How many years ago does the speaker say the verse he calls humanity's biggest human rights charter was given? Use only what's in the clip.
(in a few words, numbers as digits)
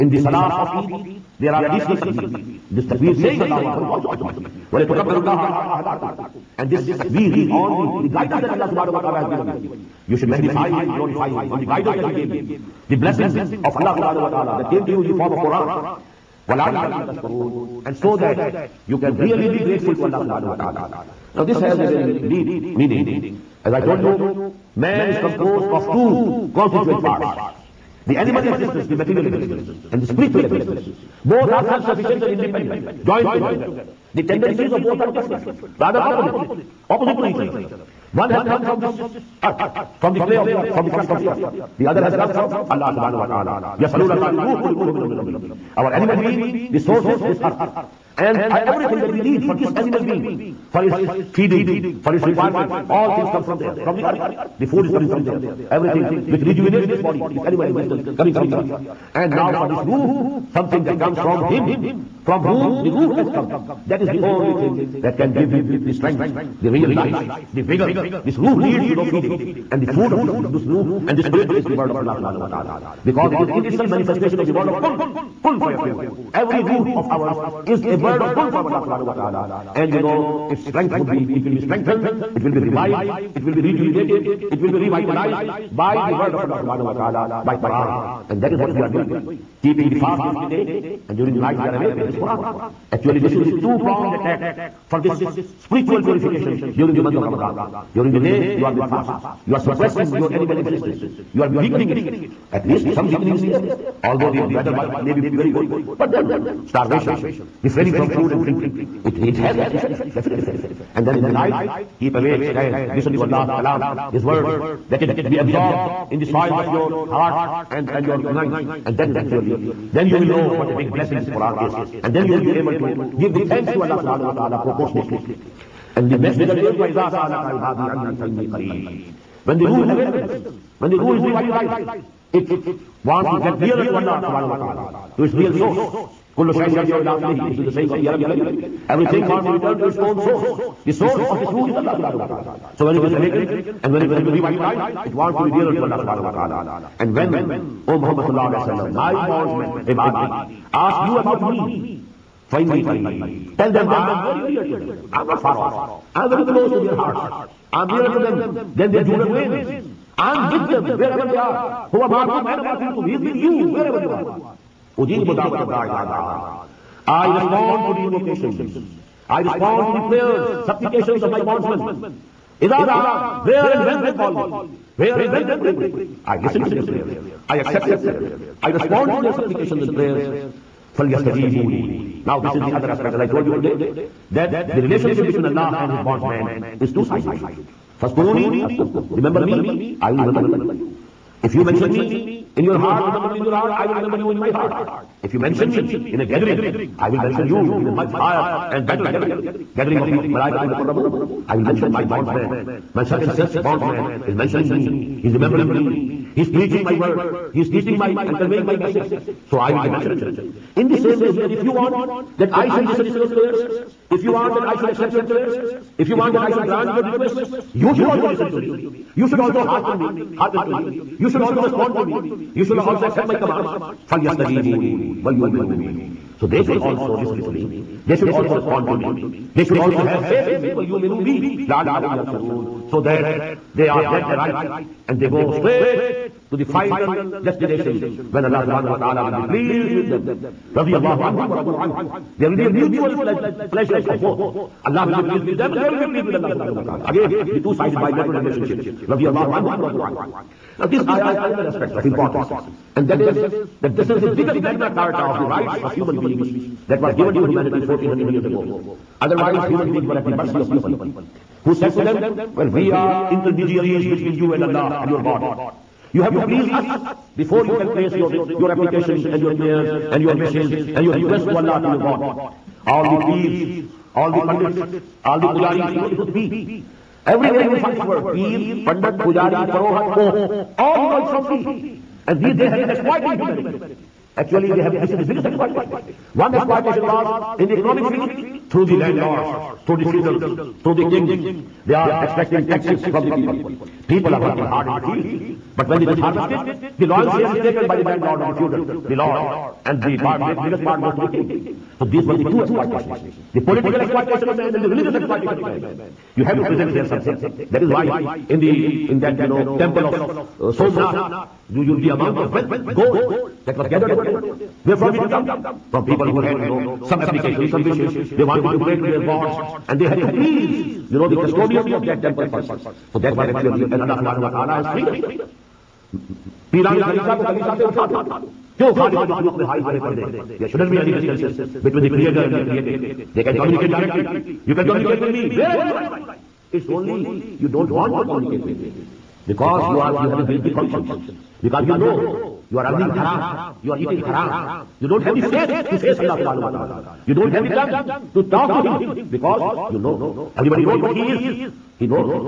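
1400 years.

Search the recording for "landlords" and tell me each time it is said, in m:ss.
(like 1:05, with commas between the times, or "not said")
4:48, 4:58.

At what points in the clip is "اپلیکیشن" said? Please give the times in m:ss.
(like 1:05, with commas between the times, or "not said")
5:17.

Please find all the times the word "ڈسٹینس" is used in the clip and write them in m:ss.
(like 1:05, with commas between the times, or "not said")
5:31.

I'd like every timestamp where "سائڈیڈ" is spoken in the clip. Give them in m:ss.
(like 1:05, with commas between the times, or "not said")
3:07.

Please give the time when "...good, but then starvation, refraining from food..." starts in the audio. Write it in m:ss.
1:45.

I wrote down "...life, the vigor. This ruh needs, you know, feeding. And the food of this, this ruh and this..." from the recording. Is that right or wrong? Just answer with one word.
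right.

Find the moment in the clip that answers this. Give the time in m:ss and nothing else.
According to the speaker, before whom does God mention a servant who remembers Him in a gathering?
3:20.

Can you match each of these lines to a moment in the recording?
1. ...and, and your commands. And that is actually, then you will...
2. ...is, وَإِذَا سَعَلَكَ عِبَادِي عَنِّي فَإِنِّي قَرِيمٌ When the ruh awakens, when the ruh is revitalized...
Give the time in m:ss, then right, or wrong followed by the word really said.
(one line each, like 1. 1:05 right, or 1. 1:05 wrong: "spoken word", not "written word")
1. 1:57 wrong: "minds", not "commands"
2. 2:06 right.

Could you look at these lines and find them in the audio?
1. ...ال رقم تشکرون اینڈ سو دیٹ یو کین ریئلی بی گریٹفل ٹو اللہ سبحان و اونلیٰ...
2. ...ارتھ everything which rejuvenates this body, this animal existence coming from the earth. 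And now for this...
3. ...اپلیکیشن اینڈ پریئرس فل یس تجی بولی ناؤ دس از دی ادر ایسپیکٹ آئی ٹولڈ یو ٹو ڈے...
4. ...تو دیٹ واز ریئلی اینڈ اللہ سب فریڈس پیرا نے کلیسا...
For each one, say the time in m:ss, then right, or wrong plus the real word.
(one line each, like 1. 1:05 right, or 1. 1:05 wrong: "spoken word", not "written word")
1. 0:16 wrong: "تعالی", not "اونلی"
2. 0:55 right
3. 2:59 wrong: "سپلیکیشن", not "اپلیکیشن"
4. 5:23 wrong: "ایکچولی", not "ریئلی".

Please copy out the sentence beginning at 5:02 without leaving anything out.
So these were the two exploitations, the political exploitation of man and the religious exploitation of man.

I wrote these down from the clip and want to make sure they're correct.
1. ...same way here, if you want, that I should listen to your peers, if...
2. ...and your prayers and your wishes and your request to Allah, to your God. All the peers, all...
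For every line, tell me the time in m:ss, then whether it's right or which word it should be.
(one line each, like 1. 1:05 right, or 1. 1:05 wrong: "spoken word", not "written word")
1. 3:30 wrong: "prayers", not "peers"
2. 4:29 right.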